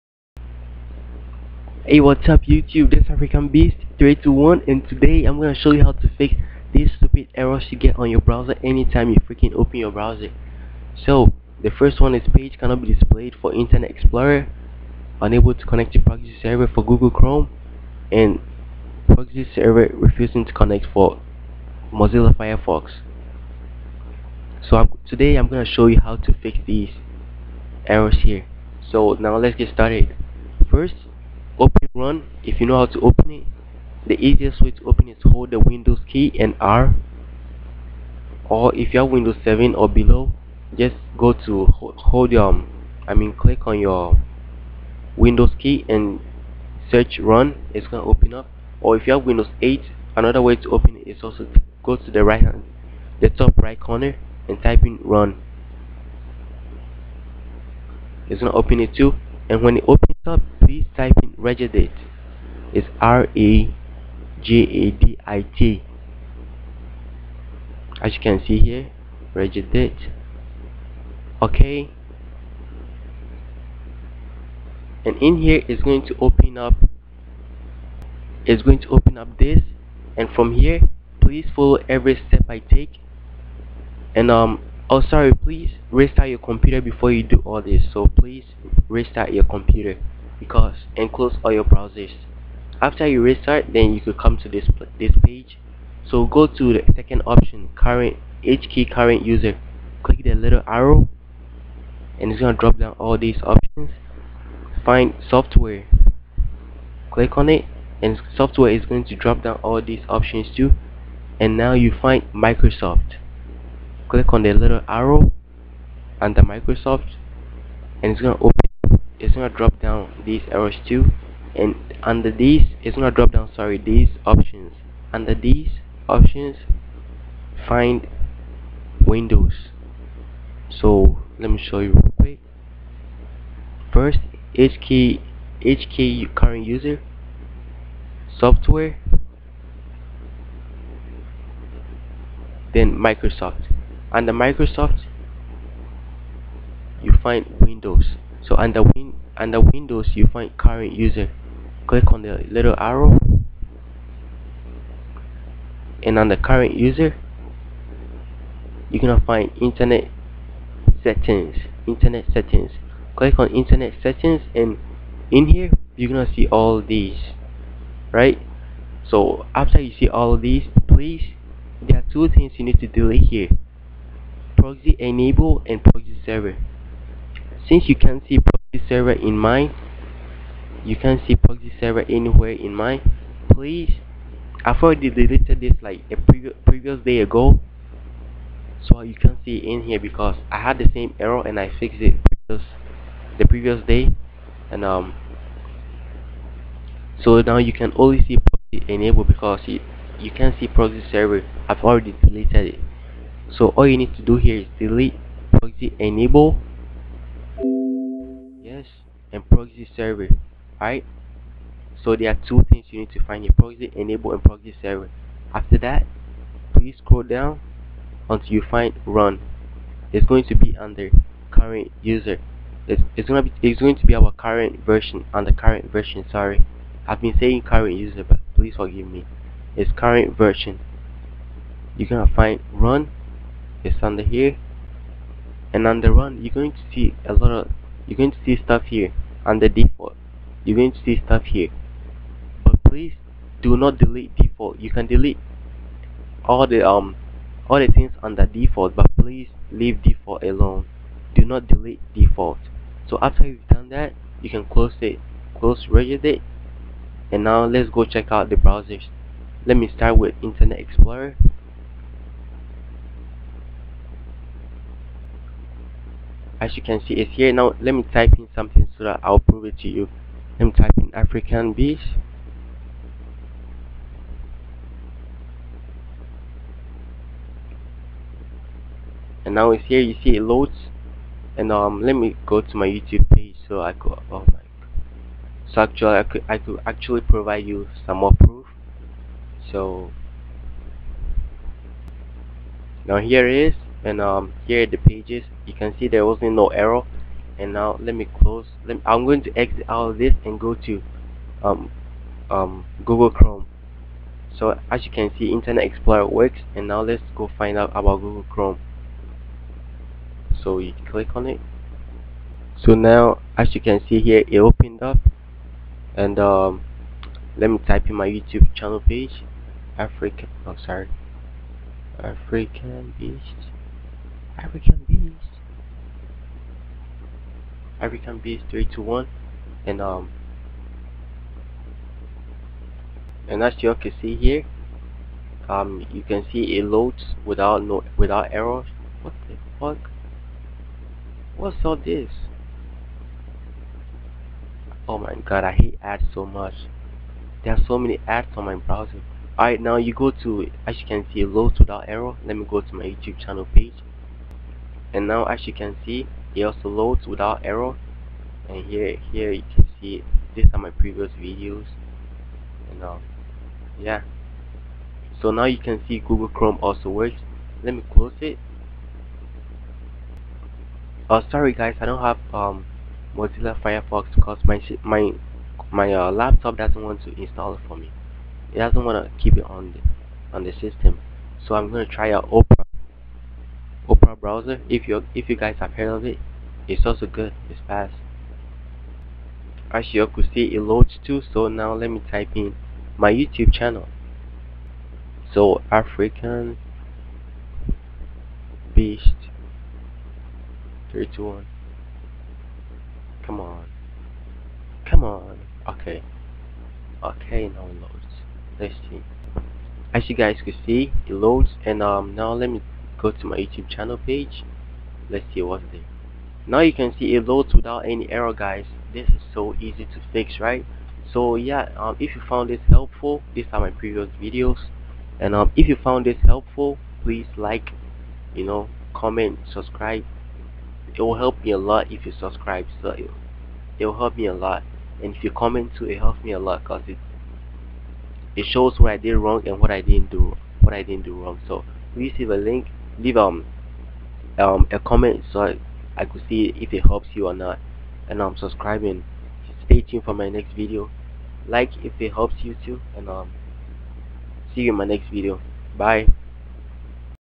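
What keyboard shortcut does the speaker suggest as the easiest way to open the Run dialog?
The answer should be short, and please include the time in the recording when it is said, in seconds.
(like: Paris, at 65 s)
Windows key and R, at 35 s.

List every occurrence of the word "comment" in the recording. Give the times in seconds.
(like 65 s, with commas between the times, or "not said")
429 s, 435 s, 444 s.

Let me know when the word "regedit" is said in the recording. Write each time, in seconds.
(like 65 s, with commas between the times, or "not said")
61 s, 69 s, 255 s.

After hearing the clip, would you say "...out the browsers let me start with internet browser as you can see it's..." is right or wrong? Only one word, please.
wrong.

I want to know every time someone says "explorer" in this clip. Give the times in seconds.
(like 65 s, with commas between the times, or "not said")
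13 s, 260 s, 305 s.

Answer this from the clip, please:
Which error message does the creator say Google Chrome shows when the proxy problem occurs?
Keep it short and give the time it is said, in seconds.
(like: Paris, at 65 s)
unable to connect to proxy server, at 15 s.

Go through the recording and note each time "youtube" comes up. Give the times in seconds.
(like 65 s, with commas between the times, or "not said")
2 s, 282 s, 318 s, 353 s, 393 s, 413 s.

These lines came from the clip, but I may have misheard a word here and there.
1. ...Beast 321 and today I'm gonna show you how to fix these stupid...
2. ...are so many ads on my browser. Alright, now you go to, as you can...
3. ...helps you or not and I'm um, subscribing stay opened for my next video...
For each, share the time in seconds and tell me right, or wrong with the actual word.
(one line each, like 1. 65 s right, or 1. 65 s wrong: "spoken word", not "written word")
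1. 3 s right
2. 347 s right
3. 447 s wrong: "tuned", not "opened".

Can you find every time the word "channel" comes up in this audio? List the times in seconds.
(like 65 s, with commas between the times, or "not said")
318 s, 353 s, 393 s, 413 s.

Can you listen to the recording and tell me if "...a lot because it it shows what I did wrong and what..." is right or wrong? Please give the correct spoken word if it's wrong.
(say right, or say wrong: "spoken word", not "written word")
right.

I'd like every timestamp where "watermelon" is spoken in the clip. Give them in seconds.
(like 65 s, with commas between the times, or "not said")
not said.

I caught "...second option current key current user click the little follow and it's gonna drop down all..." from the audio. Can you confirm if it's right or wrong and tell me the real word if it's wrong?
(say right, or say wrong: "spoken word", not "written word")
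wrong: "arrow", not "follow".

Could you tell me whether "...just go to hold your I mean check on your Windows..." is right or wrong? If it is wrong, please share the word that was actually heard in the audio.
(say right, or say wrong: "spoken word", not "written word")
wrong: "click", not "check".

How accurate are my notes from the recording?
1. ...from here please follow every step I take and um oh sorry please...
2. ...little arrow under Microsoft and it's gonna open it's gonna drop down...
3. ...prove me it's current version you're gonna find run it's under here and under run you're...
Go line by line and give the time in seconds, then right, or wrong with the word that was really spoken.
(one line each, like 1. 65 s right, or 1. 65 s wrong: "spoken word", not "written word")
1. 80 s right
2. 114 s right
3. 228 s wrong: "forgive", not "prove".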